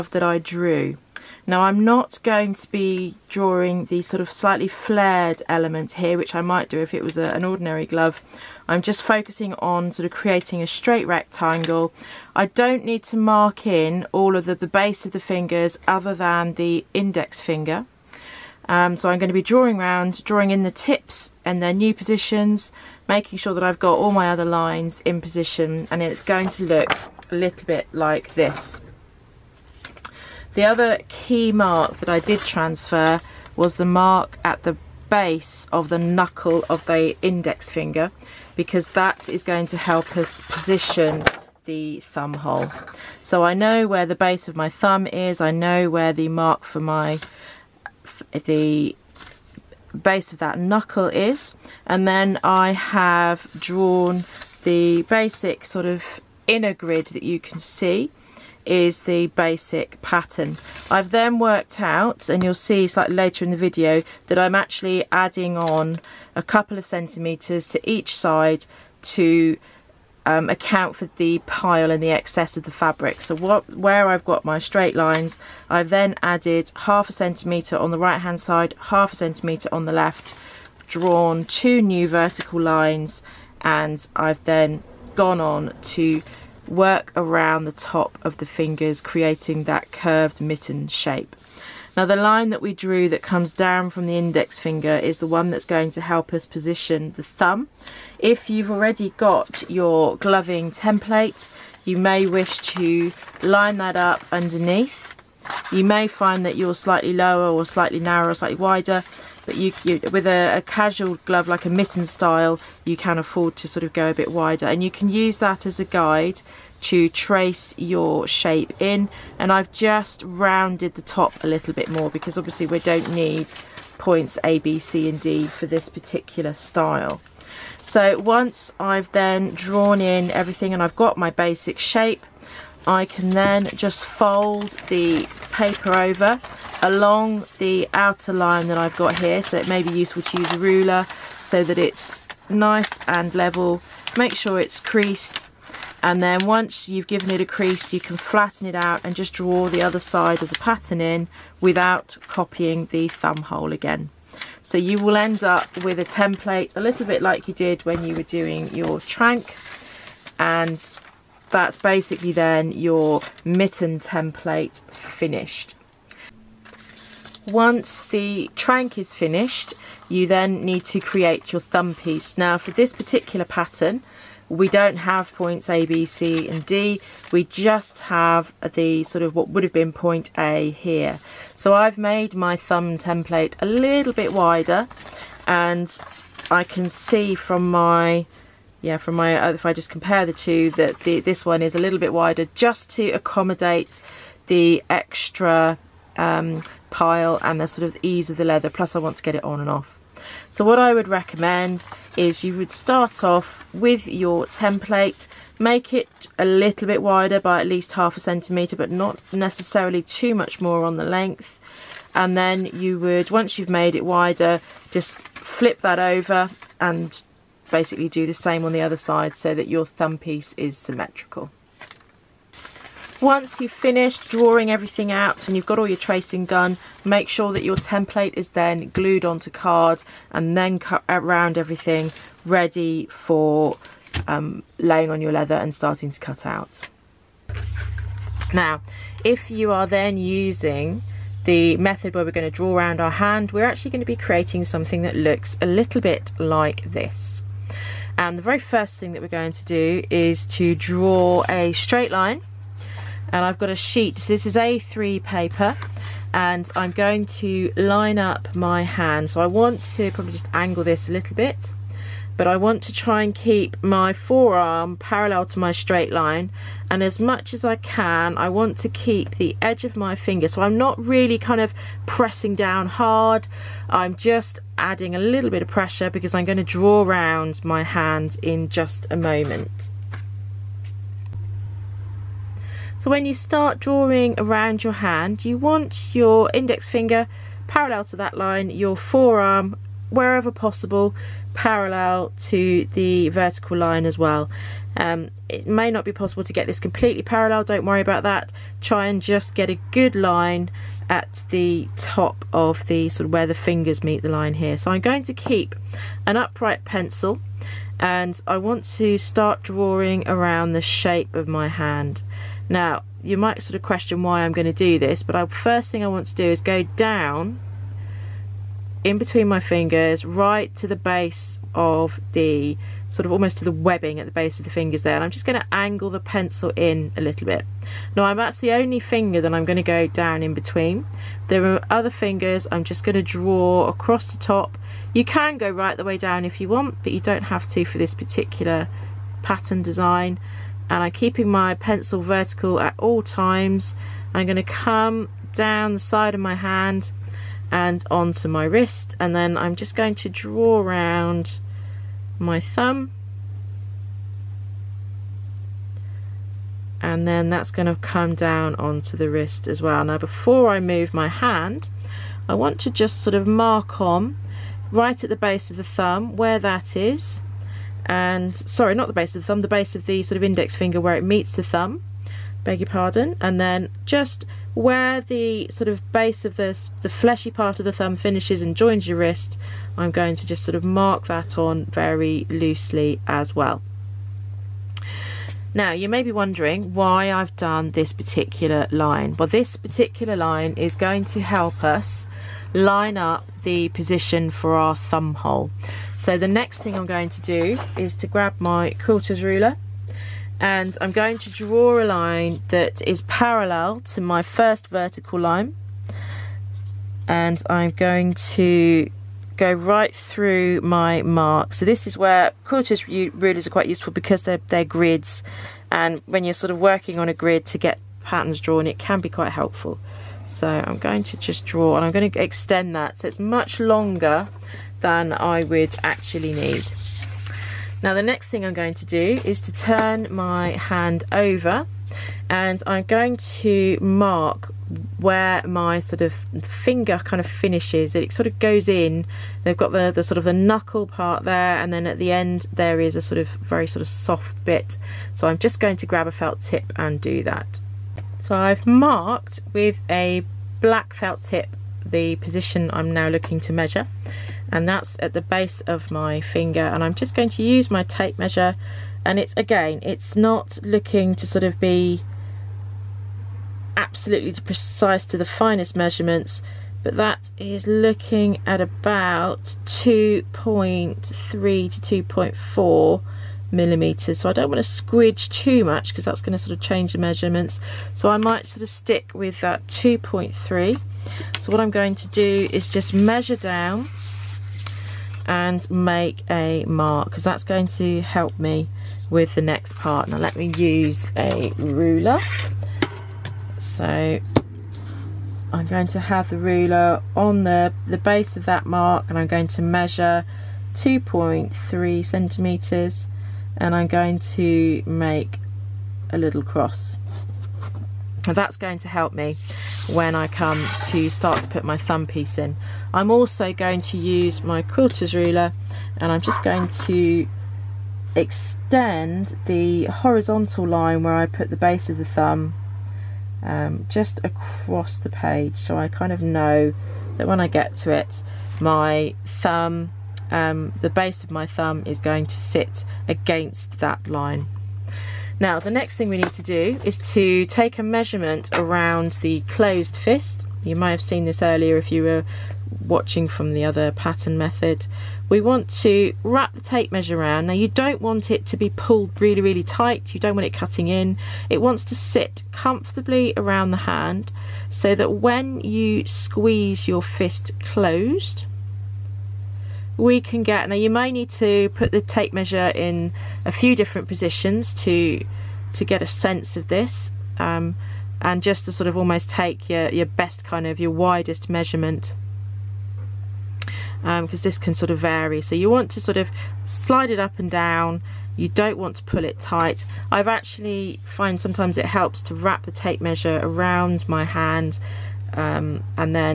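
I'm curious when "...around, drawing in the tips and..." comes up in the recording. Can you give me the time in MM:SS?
00:19.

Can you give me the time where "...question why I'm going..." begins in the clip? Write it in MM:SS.
05:13.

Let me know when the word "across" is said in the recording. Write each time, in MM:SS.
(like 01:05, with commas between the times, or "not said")
05:33, 08:44.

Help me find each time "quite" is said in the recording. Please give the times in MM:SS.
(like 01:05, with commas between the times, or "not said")
06:53, 06:59.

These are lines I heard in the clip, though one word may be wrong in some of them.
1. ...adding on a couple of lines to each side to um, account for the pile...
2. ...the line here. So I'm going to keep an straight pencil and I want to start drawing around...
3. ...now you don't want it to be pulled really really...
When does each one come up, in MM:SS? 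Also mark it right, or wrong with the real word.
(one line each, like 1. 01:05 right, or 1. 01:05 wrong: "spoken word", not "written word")
1. 01:05 wrong: "centimetres", not "lines"
2. 05:04 wrong: "upright", not "straight"
3. 09:07 right.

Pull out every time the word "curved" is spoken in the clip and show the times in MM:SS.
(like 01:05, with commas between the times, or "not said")
01:29.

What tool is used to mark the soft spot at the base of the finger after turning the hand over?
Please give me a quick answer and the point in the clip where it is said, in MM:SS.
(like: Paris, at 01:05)
black felt tip, at 07:30.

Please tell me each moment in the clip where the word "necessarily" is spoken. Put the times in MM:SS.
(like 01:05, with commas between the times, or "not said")
03:29.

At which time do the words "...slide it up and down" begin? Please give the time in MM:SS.
09:36.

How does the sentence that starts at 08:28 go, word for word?
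And that's going to help me when I come to start to put my thumb piece in.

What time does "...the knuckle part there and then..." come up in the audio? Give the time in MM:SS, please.
07:20.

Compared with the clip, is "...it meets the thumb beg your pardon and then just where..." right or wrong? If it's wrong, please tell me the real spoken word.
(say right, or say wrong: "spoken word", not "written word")
right.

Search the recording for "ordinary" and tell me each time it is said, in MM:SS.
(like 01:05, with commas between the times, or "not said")
00:07.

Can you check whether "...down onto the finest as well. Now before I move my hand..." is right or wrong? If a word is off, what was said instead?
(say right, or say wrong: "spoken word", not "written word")
wrong: "wrist", not "finest".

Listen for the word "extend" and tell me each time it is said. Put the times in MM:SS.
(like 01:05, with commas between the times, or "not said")
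07:02, 08:38.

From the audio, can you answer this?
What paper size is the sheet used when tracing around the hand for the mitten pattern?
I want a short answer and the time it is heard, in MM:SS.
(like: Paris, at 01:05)
A3, at 04:14.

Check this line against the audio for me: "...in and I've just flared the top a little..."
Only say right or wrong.
wrong.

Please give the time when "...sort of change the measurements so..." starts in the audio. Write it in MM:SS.
07:56.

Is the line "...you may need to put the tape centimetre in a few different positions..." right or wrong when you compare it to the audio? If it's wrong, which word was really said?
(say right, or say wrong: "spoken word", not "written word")
wrong: "measure", not "centimetre".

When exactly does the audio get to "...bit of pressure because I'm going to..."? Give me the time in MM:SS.
04:35.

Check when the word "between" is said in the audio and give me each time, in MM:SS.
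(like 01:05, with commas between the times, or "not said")
05:19, 05:30.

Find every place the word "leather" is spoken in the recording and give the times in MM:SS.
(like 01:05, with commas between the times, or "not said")
03:18, 03:55.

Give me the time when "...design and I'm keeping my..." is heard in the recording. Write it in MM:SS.
05:39.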